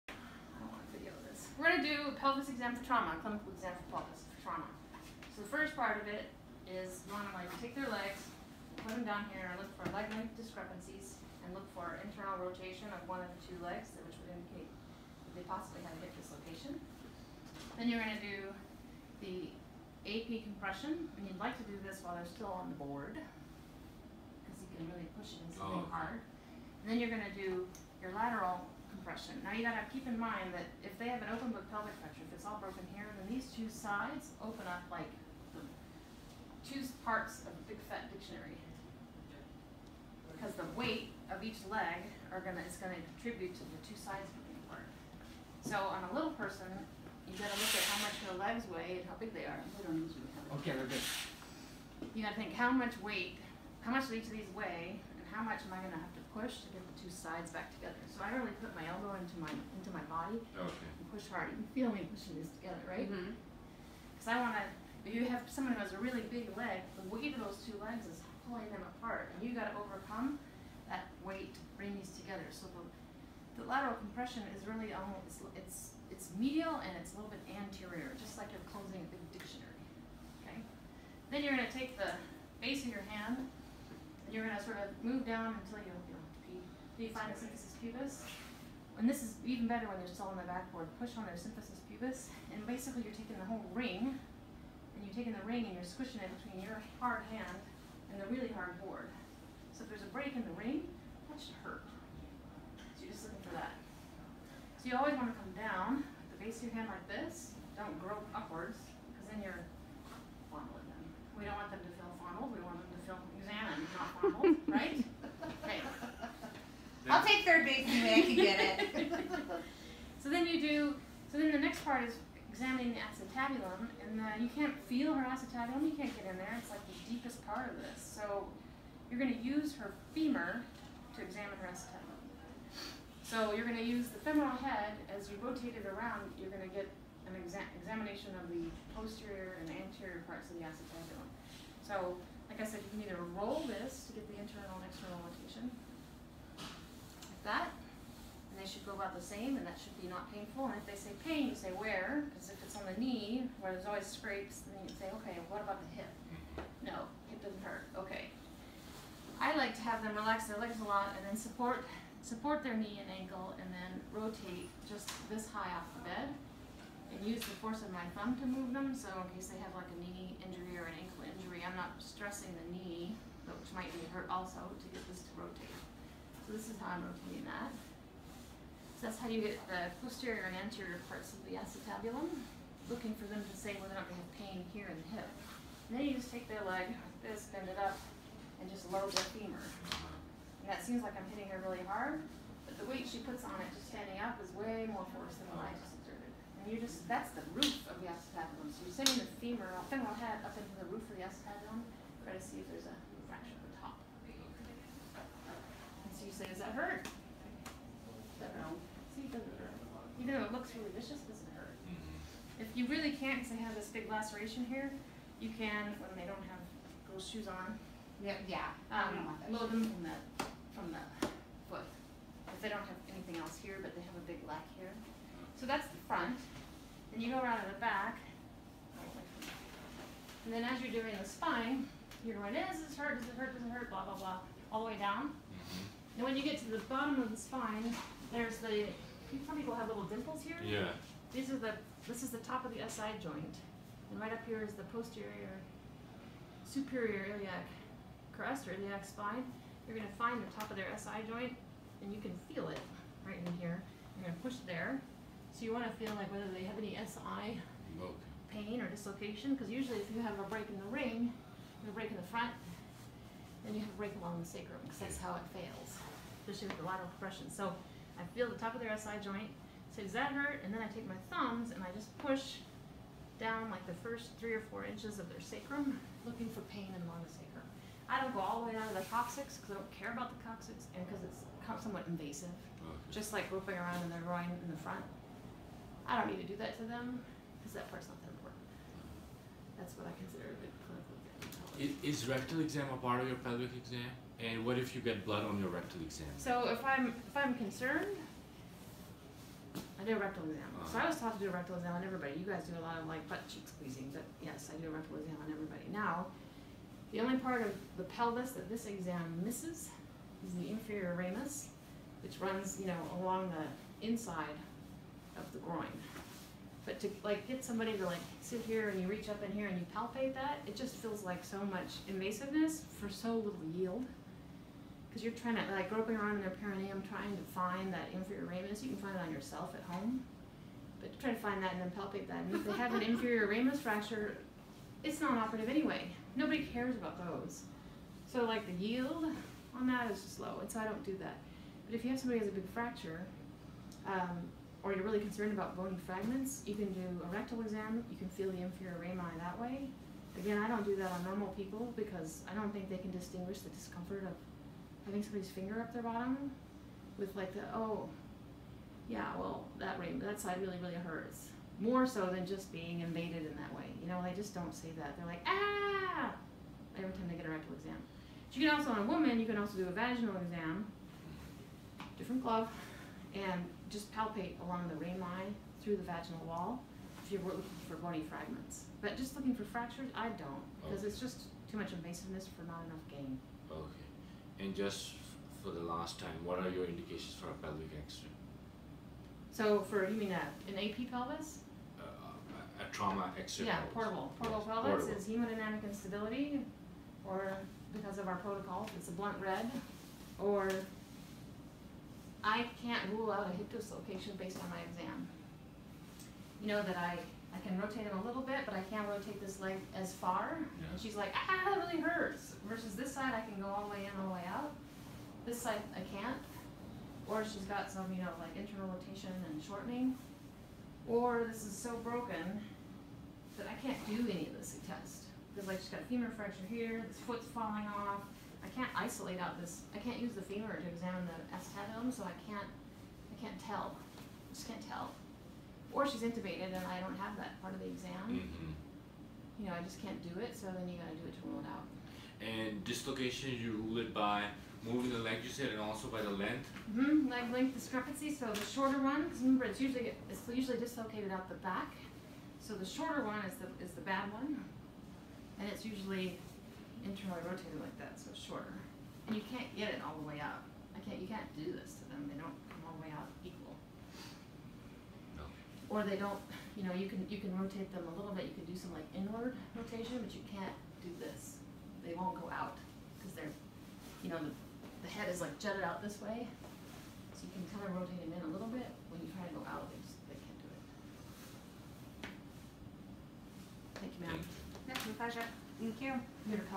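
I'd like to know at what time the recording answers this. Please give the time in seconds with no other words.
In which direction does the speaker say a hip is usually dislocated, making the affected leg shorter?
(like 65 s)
451 s.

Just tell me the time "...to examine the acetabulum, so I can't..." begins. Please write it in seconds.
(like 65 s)
430 s.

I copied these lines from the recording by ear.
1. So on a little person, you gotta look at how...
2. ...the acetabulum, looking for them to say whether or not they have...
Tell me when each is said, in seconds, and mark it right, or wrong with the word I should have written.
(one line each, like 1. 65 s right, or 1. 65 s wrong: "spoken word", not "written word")
1. 45 s right
2. 181 s right.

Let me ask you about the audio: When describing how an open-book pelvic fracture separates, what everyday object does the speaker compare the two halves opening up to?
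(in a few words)
big fat dictionary.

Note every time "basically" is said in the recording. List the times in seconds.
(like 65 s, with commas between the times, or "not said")
92 s.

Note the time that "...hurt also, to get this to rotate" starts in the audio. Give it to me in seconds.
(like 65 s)
174 s.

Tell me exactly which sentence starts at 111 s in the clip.
We don't want them to feel fondled.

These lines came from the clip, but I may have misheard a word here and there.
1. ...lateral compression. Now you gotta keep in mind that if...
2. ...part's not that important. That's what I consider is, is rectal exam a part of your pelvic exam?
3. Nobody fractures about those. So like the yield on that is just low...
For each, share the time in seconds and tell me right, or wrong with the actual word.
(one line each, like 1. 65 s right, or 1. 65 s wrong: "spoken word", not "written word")
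1. 28 s right
2. 287 s right
3. 336 s wrong: "cares", not "fractures".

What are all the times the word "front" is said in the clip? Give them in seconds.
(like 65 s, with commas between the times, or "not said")
226 s, 262 s, 284 s.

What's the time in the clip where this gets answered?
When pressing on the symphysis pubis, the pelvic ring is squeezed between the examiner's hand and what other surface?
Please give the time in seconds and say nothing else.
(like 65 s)
98 s.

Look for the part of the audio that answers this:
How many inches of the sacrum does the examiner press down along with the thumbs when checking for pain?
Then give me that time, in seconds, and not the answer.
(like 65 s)
274 s.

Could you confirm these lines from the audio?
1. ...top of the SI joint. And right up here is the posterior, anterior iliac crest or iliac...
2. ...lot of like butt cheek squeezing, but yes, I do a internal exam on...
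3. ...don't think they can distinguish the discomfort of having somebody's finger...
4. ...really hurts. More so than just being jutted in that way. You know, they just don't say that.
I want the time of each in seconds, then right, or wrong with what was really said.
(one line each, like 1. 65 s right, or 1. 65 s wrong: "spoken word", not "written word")
1. 242 s wrong: "superior", not "anterior"
2. 302 s wrong: "rectal", not "internal"
3. 352 s right
4. 360 s wrong: "invaded", not "jutted".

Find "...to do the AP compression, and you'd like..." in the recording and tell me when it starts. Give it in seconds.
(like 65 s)
18 s.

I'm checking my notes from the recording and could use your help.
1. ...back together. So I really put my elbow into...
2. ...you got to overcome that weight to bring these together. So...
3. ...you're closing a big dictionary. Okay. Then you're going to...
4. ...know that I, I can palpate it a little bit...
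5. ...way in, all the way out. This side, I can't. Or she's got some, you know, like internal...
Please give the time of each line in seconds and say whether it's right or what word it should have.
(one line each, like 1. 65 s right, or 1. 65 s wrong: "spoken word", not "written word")
1. 57 s right
2. 69 s right
3. 78 s right
4. 406 s wrong: "rotate", not "palpate"
5. 413 s right.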